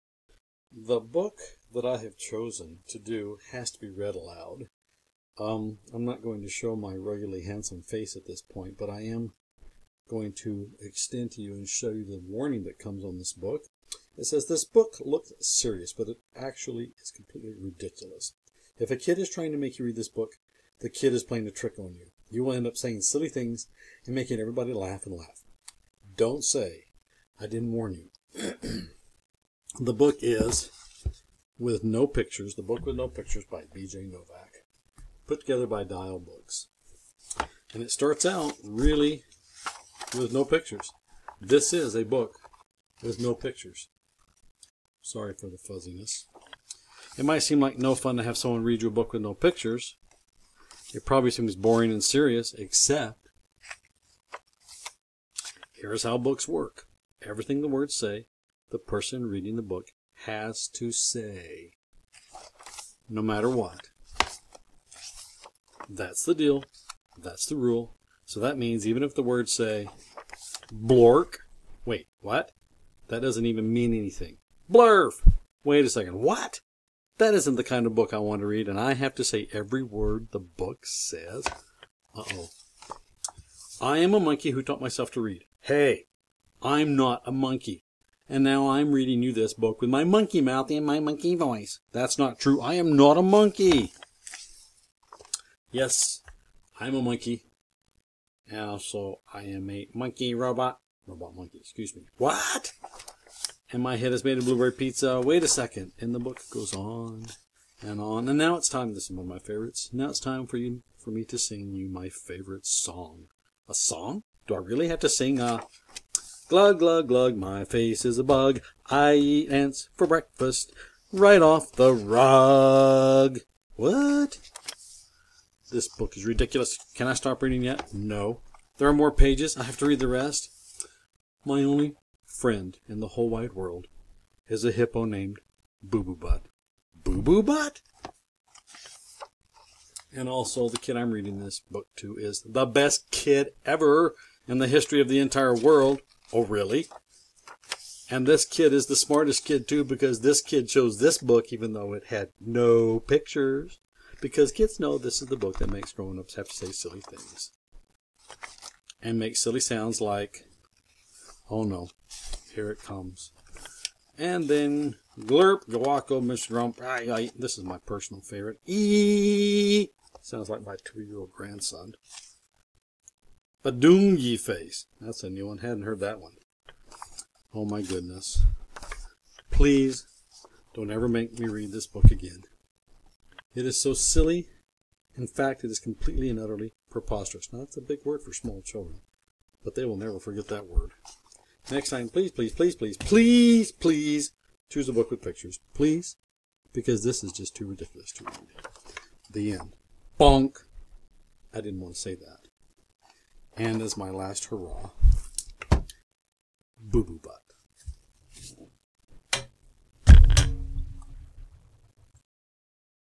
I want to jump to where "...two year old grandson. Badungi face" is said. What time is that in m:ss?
2:50.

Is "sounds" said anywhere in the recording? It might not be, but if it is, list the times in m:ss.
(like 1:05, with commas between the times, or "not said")
2:39, 2:50.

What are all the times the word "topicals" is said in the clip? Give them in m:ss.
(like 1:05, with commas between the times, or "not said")
not said.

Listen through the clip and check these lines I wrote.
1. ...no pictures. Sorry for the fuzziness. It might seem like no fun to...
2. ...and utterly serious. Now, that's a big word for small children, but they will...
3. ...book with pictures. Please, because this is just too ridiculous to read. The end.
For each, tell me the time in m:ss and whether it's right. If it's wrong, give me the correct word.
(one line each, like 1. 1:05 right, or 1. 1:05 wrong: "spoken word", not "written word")
1. 0:43 right
2. 3:06 wrong: "preposterous", not "serious"
3. 3:14 right.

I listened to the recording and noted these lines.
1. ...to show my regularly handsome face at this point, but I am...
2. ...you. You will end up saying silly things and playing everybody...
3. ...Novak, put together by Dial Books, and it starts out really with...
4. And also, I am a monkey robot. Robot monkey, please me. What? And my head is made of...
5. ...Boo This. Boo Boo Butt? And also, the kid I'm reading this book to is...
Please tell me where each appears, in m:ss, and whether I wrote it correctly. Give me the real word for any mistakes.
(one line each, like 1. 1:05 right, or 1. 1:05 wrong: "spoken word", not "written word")
1. 0:06 right
2. 0:21 wrong: "making", not "playing"
3. 0:34 right
4. 1:38 wrong: "excuse", not "please"
5. 2:16 wrong: "Butt", not "This".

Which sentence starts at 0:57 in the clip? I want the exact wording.
Everything the words say the person reading the book has to say, no matter what.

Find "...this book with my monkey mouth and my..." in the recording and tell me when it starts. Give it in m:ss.
1:29.